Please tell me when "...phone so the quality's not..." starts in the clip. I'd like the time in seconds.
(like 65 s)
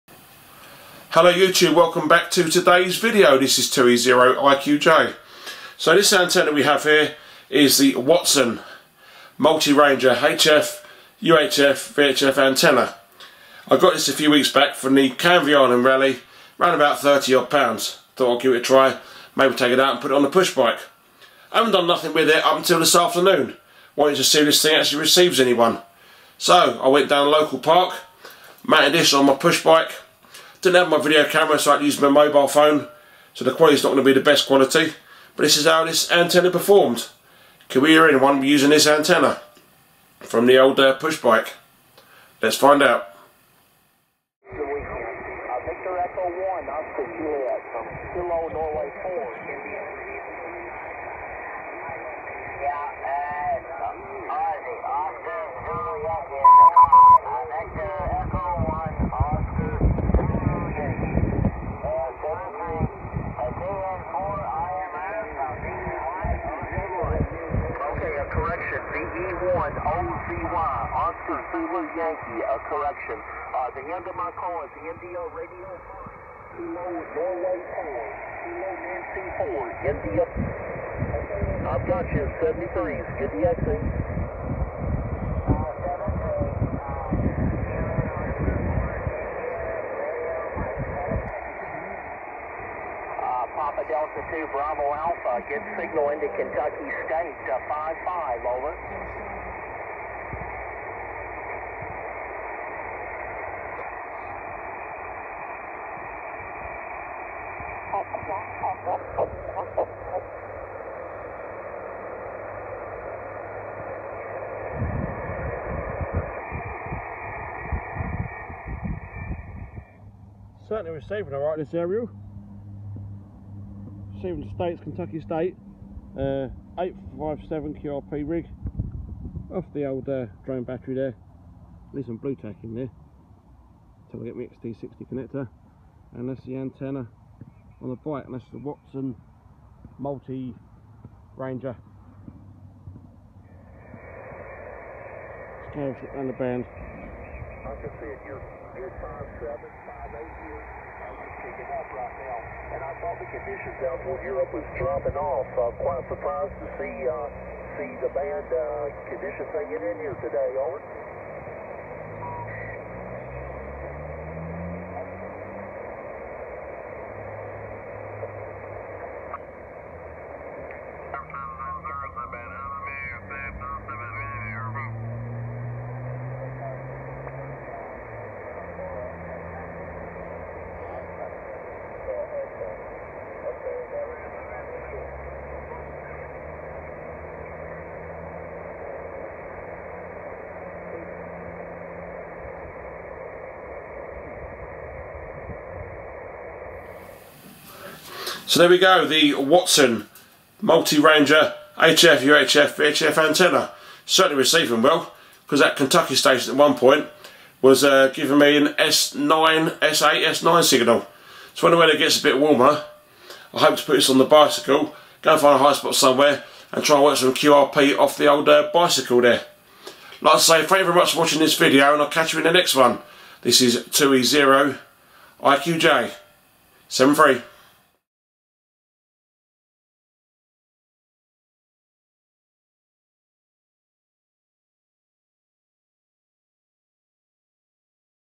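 32 s.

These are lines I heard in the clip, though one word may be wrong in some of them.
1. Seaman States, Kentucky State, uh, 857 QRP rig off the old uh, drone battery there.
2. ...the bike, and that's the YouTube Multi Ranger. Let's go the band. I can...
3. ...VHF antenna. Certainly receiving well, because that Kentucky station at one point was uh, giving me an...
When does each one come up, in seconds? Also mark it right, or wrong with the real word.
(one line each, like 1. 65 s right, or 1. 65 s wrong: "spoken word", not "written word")
1. 124 s right
2. 137 s wrong: "Watson", not "YouTube"
3. 202 s right.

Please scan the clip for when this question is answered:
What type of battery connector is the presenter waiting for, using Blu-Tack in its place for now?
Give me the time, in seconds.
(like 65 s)
134 s.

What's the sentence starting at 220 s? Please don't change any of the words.
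Like I say, thank you very much for watching this video, and I'll catch you in the next one.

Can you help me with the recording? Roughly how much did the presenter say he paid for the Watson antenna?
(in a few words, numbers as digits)
30 odd pounds.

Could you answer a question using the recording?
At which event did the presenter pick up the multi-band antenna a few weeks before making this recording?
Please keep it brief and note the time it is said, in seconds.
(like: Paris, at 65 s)
Canvey Island Rally, at 15 s.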